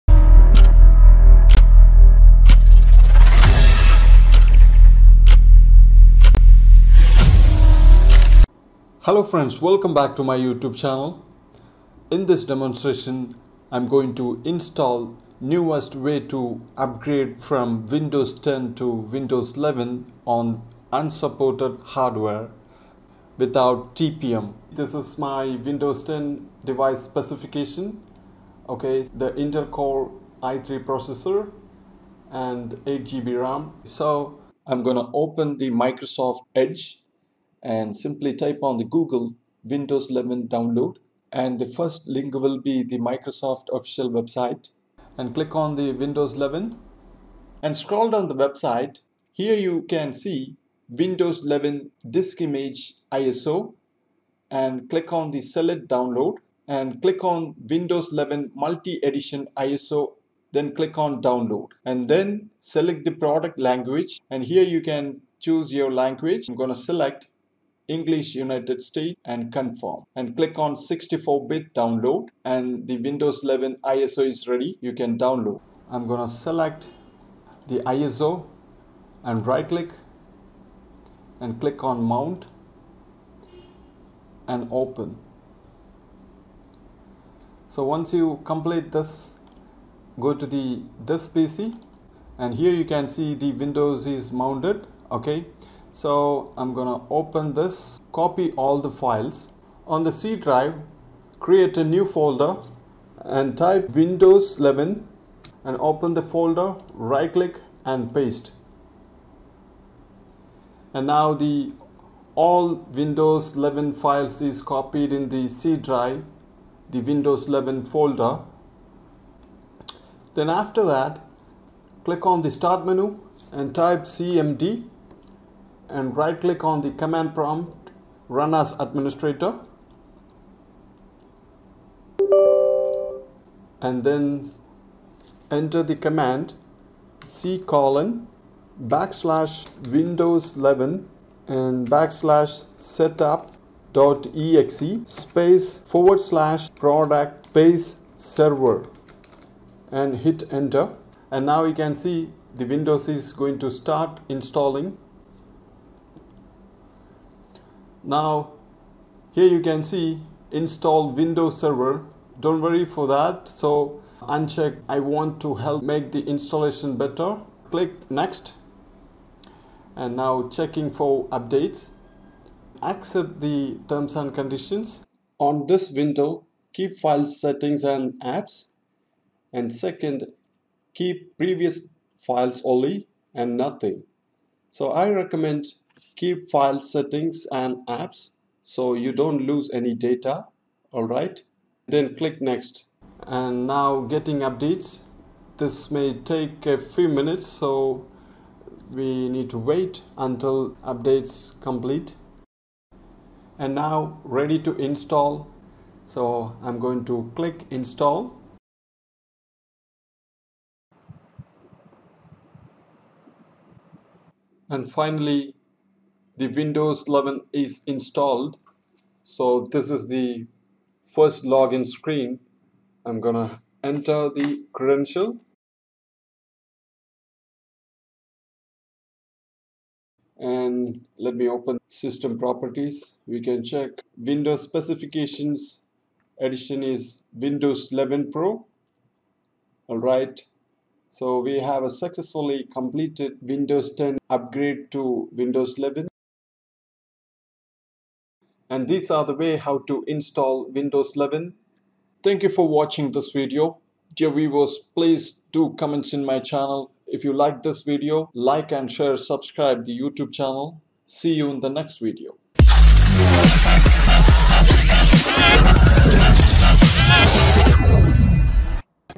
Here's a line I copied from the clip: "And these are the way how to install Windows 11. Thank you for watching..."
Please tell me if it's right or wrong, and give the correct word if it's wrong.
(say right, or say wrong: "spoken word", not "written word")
right.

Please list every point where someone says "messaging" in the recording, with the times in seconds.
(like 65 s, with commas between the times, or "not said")
not said.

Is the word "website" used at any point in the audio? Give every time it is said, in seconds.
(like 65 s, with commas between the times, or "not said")
44 s, 48 s.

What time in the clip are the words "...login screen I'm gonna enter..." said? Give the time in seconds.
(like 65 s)
221 s.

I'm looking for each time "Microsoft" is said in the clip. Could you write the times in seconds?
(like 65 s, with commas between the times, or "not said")
35 s, 42 s.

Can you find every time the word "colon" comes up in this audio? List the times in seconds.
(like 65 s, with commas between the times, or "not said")
137 s.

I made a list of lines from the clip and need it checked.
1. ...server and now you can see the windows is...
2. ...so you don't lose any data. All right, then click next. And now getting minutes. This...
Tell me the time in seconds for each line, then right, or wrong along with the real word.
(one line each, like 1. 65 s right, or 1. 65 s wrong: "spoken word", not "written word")
1. 150 s wrong: "enter", not "server"
2. 188 s wrong: "updates", not "minutes".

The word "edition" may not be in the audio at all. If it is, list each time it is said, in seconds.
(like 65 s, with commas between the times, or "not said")
58 s, 236 s.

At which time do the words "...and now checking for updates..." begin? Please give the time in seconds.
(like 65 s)
169 s.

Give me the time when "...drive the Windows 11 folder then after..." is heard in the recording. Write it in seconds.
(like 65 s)
115 s.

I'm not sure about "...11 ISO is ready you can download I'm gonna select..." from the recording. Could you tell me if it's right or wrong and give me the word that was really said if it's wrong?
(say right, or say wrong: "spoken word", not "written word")
right.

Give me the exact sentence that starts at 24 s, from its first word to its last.
This is my Windows 10 device specification.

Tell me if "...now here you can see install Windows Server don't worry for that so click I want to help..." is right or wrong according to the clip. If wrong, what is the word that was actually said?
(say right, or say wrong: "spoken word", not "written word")
wrong: "uncheck", not "click".